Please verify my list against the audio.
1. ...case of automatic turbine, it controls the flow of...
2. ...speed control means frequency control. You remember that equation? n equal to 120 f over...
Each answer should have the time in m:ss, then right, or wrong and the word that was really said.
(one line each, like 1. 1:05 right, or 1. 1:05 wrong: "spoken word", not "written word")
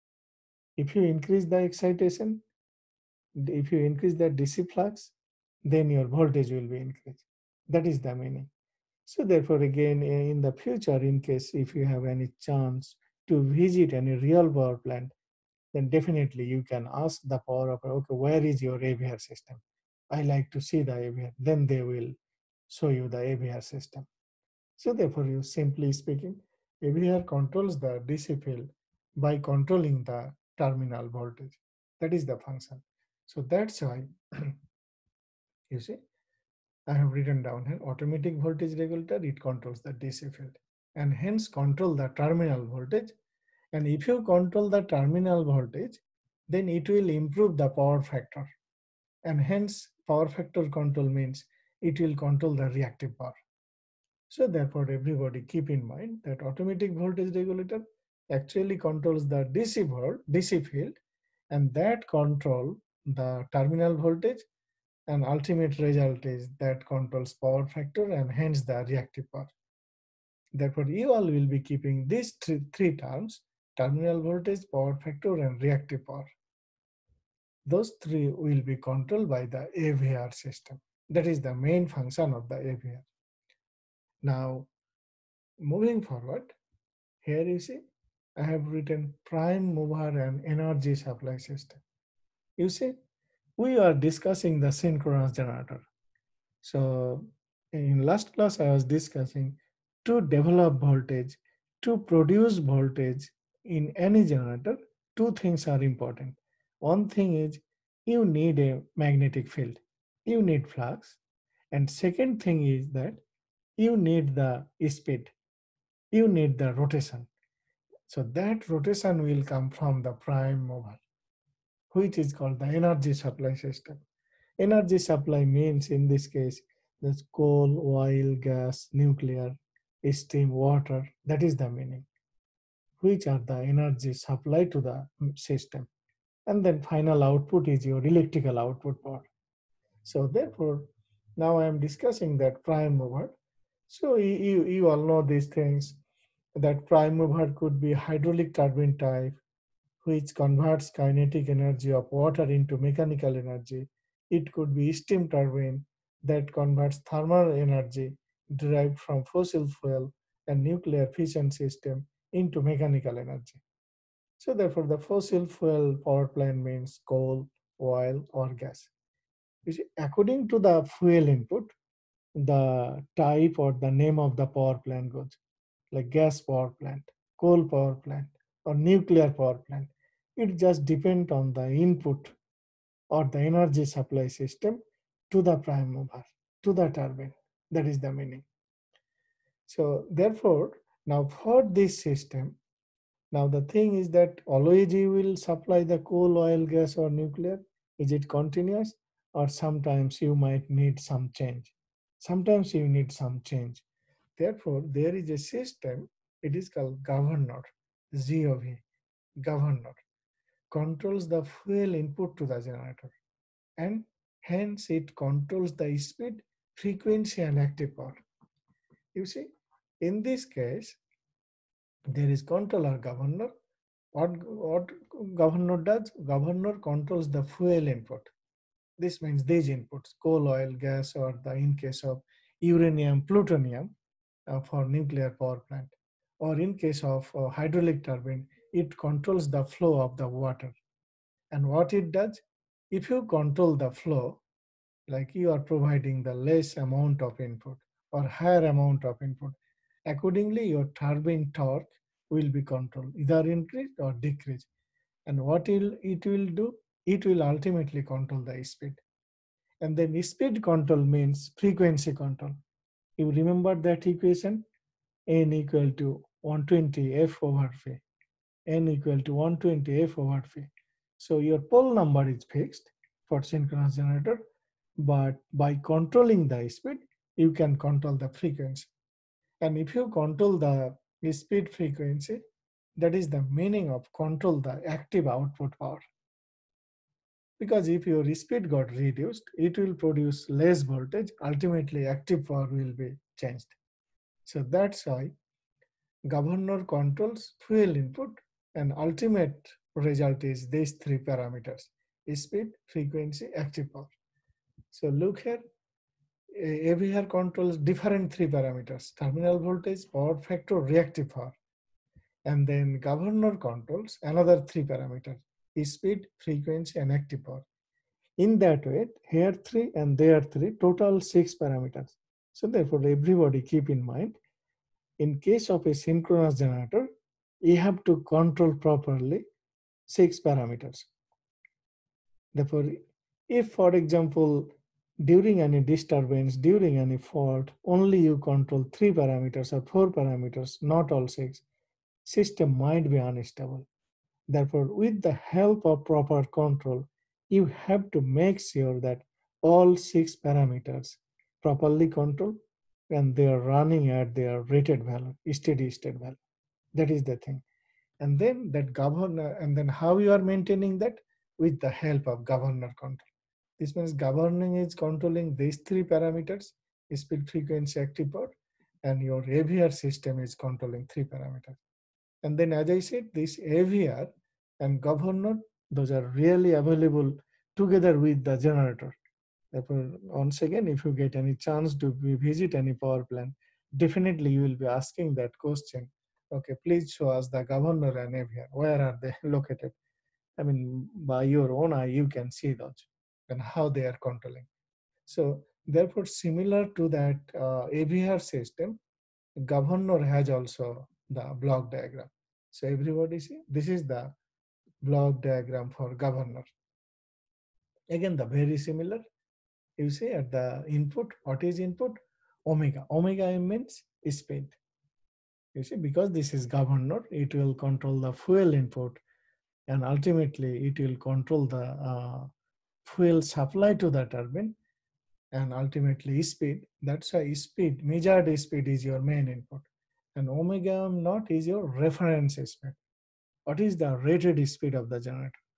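1. 3:56 wrong: "hydraulic", not "automatic"
2. 4:20 right.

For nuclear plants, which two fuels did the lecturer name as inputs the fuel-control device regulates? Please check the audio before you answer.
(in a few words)
uranium, plutonium.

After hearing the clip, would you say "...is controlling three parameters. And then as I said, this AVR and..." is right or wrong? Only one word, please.
right.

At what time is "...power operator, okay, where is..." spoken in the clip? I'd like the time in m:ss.
0:17.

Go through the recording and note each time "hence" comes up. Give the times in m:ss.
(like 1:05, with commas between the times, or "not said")
0:41, 0:49, 1:08, 3:34.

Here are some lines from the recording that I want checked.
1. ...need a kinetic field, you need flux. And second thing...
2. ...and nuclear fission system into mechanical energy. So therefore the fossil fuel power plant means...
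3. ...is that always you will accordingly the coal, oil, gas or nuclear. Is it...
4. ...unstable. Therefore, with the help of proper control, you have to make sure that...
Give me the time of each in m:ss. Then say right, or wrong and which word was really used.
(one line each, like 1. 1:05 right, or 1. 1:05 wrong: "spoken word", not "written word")
1. 1:48 wrong: "magnetic", not "kinetic"
2. 2:40 right
3. 3:13 wrong: "supply", not "accordingly"
4. 5:43 right.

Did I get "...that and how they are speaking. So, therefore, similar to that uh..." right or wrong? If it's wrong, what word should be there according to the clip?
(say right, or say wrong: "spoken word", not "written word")
wrong: "controlling", not "speaking".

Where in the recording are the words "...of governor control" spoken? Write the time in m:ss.
6:02.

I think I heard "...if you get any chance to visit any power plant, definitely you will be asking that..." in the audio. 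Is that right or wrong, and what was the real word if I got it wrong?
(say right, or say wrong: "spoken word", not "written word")
right.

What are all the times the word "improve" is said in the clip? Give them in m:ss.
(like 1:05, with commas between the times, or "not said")
0:47.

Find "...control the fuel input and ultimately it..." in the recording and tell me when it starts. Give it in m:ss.
6:57.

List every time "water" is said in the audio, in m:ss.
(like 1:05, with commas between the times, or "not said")
2:10, 2:32, 4:00.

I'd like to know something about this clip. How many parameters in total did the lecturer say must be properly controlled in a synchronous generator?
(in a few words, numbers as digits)
6.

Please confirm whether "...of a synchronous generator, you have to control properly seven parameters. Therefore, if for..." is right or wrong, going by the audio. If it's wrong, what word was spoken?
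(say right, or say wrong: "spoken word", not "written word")
wrong: "six", not "seven".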